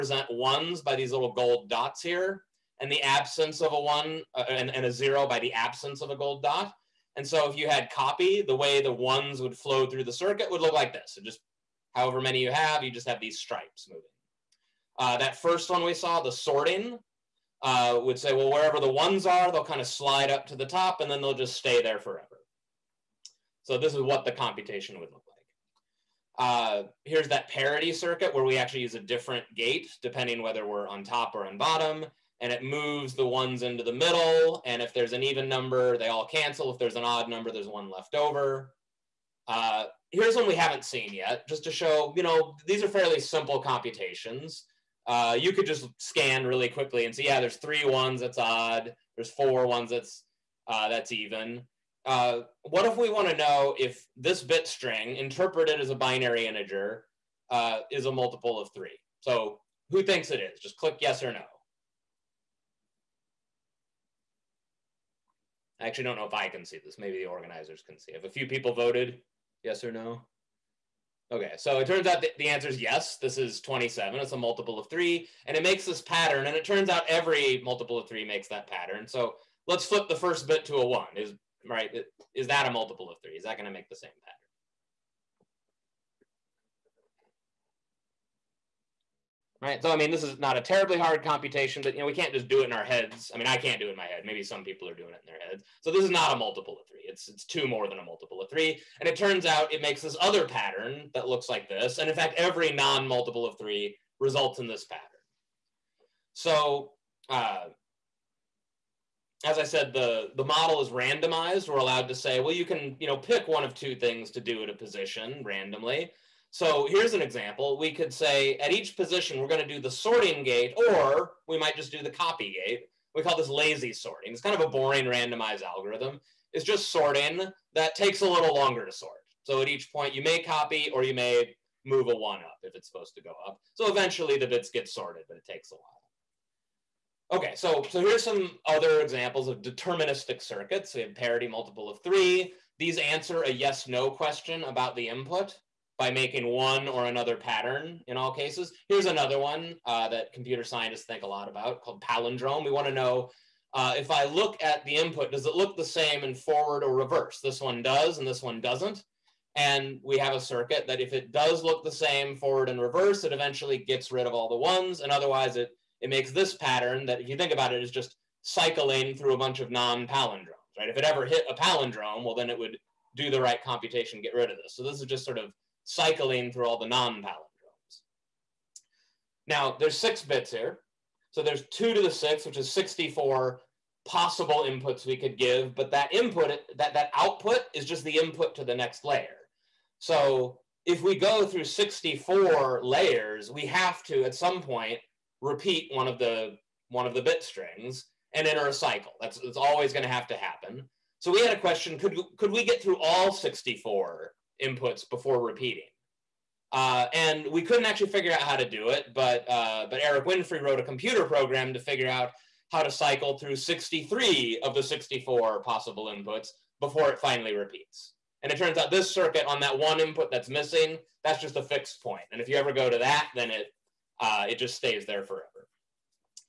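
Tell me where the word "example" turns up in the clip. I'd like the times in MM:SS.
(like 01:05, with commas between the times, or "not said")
01:57, 02:19.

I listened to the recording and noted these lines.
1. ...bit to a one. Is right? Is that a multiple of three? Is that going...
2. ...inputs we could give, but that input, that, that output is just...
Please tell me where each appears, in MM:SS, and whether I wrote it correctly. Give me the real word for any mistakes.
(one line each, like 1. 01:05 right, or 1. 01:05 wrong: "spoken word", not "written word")
1. 01:20 right
2. 03:04 right.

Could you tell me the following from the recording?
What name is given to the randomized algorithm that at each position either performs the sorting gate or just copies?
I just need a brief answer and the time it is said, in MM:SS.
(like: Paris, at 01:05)
Lazy sorting, at 02:03.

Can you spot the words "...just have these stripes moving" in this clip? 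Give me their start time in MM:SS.
00:12.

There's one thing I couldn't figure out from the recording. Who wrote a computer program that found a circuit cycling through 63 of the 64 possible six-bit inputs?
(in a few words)
Erik Winfree.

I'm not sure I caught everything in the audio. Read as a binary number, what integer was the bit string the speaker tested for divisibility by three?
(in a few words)
27.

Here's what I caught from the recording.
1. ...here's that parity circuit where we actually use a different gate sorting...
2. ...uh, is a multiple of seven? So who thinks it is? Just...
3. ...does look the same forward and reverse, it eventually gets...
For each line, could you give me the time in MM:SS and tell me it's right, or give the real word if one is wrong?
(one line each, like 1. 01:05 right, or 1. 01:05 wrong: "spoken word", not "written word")
1. 00:27 wrong: "depending", not "sorting"
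2. 00:57 wrong: "three", not "seven"
3. 02:41 right.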